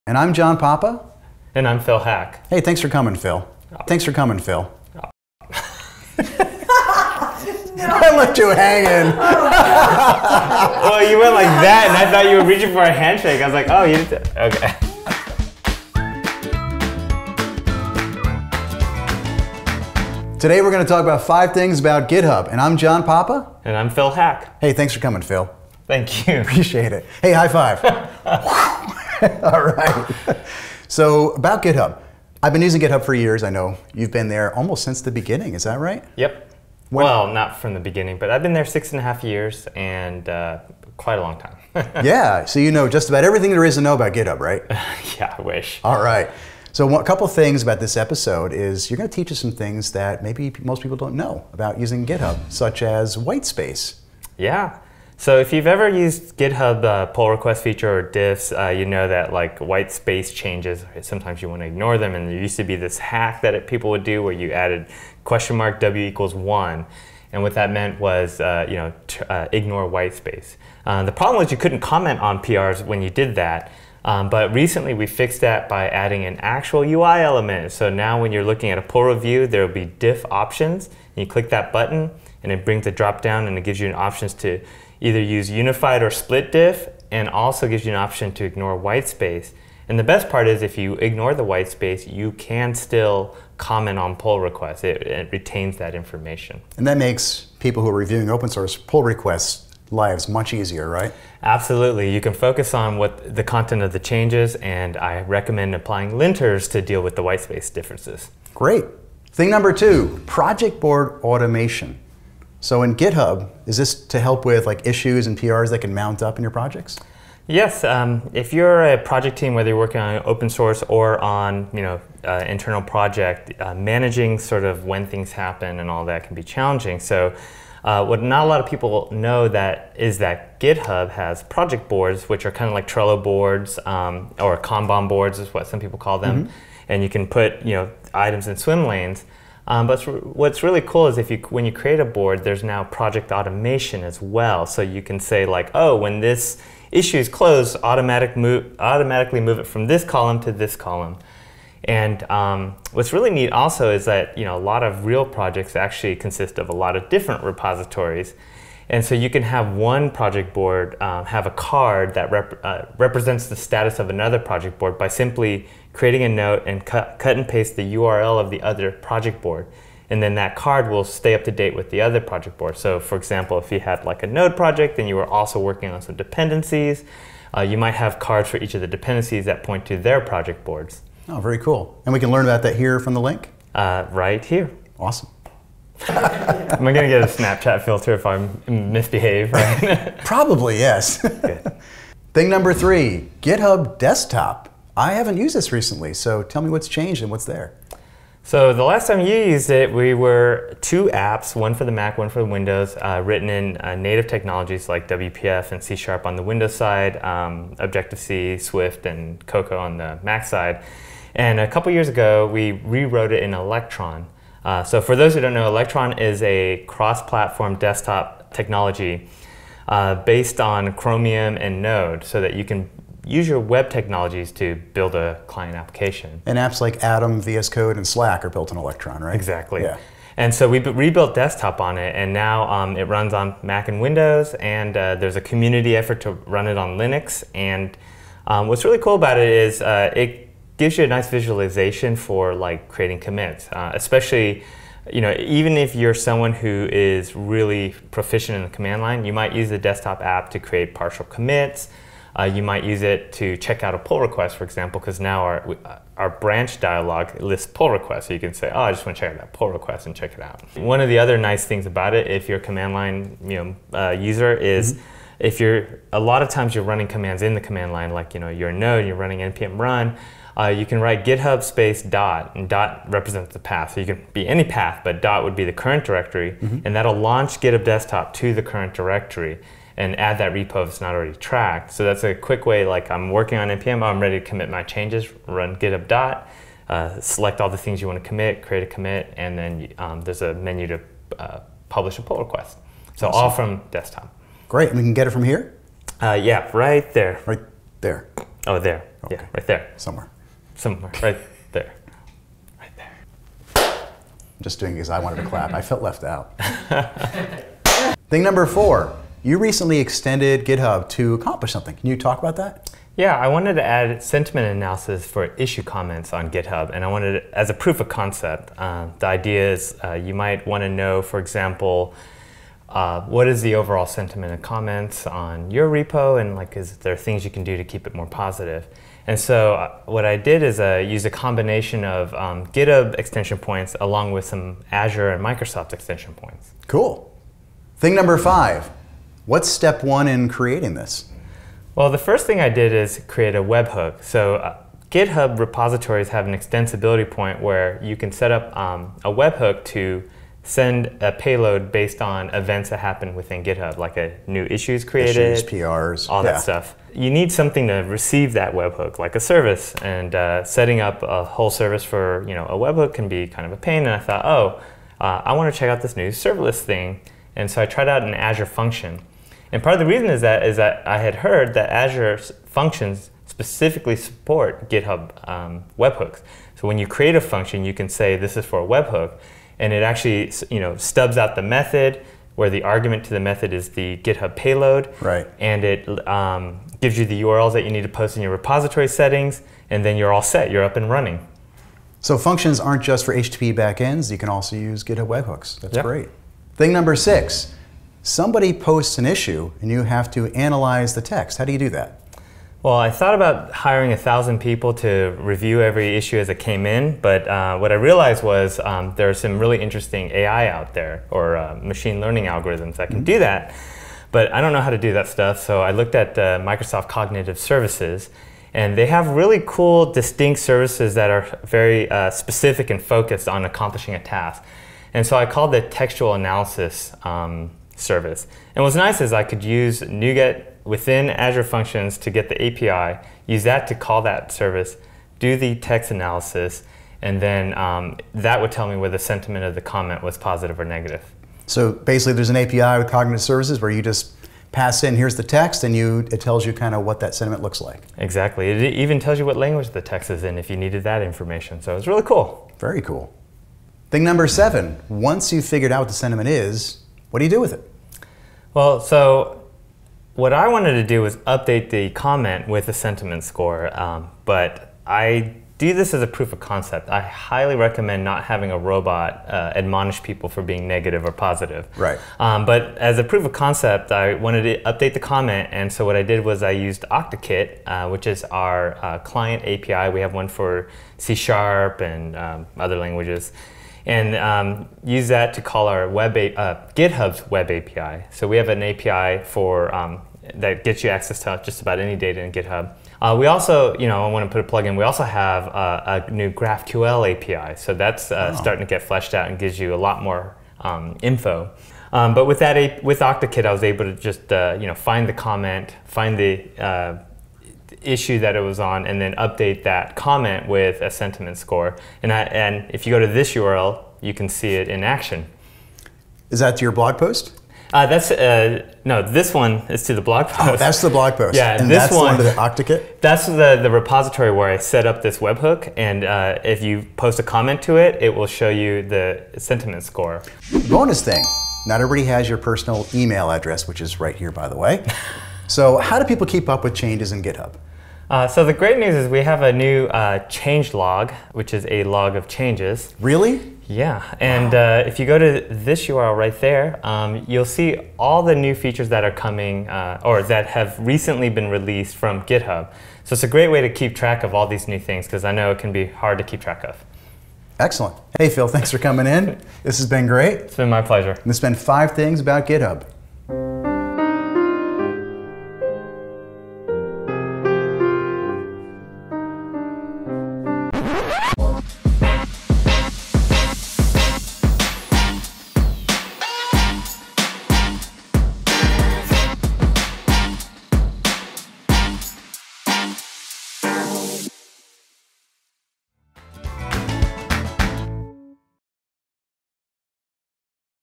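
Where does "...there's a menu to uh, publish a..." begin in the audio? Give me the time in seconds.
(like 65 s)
290 s.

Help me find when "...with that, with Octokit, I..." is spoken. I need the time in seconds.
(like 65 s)
502 s.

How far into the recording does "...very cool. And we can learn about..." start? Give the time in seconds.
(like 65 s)
181 s.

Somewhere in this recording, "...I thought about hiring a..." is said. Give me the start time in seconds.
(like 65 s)
402 s.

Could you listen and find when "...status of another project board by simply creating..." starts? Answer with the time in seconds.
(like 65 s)
163 s.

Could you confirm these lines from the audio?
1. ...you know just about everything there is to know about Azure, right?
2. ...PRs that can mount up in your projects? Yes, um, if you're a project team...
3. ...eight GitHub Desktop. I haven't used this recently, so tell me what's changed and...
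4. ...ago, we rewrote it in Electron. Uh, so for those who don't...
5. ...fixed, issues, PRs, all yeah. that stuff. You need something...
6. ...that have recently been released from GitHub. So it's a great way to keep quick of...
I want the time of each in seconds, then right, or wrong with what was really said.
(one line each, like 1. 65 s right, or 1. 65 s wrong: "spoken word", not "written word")
1. 42 s wrong: "GitHub", not "Azure"
2. 115 s right
3. 192 s wrong: "three", not "eight"
4. 212 s right
5. 355 s wrong: "created", not "fixed"
6. 550 s wrong: "track", not "quick".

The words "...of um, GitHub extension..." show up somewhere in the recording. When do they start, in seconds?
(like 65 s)
332 s.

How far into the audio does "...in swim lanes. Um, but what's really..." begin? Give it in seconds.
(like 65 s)
138 s.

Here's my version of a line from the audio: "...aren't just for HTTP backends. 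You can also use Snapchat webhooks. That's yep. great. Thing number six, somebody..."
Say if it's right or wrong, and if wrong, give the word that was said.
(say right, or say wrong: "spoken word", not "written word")
wrong: "GitHub", not "Snapchat".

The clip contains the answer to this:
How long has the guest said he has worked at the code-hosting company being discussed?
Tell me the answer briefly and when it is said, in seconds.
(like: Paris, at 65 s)
6 and a half years, at 38 s.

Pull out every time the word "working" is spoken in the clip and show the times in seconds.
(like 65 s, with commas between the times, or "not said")
119 s, 175 s, 283 s.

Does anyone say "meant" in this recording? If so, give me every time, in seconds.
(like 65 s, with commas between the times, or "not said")
67 s.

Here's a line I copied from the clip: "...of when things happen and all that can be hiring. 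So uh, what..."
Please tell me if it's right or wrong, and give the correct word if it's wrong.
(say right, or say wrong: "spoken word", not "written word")
wrong: "challenging", not "hiring".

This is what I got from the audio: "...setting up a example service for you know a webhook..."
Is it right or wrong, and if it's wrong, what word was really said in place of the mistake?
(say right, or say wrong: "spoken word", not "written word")
wrong: "whole", not "example".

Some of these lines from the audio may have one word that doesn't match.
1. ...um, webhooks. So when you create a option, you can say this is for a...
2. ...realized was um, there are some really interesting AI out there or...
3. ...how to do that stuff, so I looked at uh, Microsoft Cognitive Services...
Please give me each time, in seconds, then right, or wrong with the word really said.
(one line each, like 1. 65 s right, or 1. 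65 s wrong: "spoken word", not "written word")
1. 375 s wrong: "function", not "option"
2. 407 s right
3. 414 s right.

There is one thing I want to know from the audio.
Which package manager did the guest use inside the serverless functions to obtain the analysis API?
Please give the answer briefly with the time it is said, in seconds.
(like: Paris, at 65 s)
NuGet, at 430 s.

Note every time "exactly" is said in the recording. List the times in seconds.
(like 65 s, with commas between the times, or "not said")
229 s, 448 s.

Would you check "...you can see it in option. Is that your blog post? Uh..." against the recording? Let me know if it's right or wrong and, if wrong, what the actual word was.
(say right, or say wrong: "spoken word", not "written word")
wrong: "action", not "option".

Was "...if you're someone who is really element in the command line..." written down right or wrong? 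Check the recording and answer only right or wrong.
wrong.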